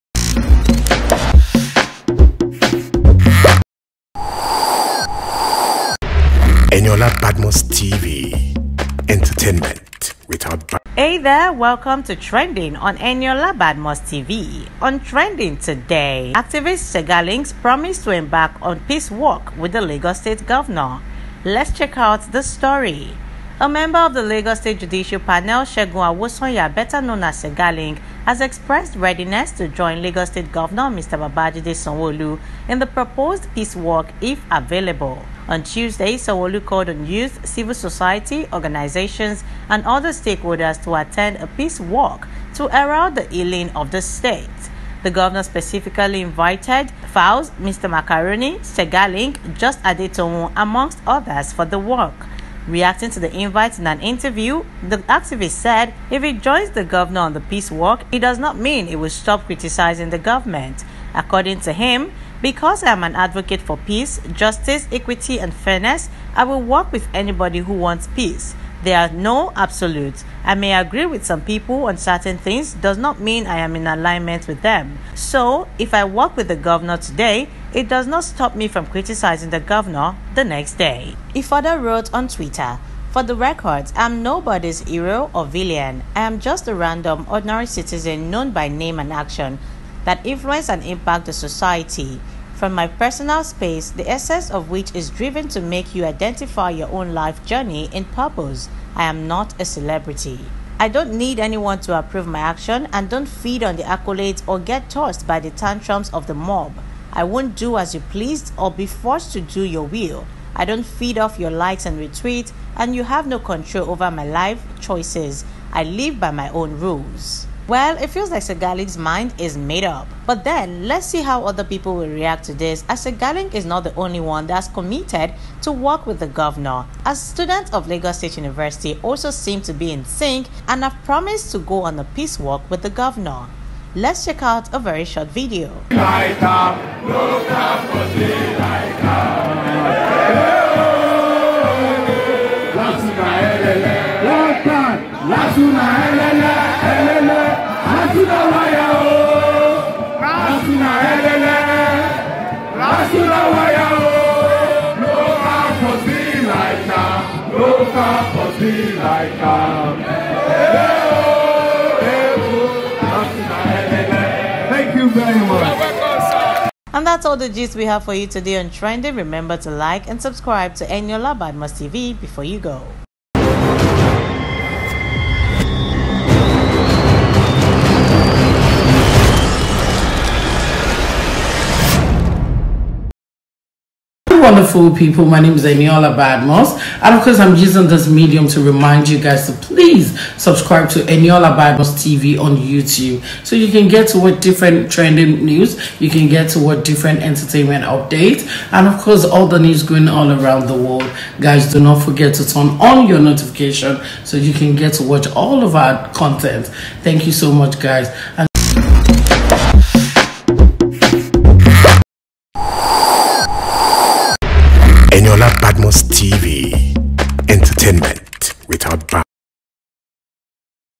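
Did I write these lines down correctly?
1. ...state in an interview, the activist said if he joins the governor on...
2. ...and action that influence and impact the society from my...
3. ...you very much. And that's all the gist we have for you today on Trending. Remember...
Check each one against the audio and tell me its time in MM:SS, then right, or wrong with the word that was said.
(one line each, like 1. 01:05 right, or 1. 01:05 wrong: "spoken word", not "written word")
1. 00:53 wrong: "invite", not "state"
2. 01:28 right
3. 02:44 right.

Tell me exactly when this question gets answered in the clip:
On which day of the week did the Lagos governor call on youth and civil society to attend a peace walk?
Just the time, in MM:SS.
00:35.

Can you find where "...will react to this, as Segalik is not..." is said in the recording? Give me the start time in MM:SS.
02:01.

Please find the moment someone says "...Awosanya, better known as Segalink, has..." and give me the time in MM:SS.
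00:26.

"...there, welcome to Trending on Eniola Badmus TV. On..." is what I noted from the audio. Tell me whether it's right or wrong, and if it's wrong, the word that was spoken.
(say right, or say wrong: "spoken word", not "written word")
right.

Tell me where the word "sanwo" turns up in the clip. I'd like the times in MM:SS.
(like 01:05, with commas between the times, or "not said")
00:31, 00:36.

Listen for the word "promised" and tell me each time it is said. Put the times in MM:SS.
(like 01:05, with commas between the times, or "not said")
00:17, 02:11.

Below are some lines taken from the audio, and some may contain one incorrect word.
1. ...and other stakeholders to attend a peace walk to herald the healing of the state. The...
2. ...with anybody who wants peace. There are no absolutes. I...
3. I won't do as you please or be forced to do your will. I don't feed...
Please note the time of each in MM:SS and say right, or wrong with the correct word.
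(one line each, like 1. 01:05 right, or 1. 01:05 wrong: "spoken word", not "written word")
1. 00:39 right
2. 01:06 right
3. 01:47 right.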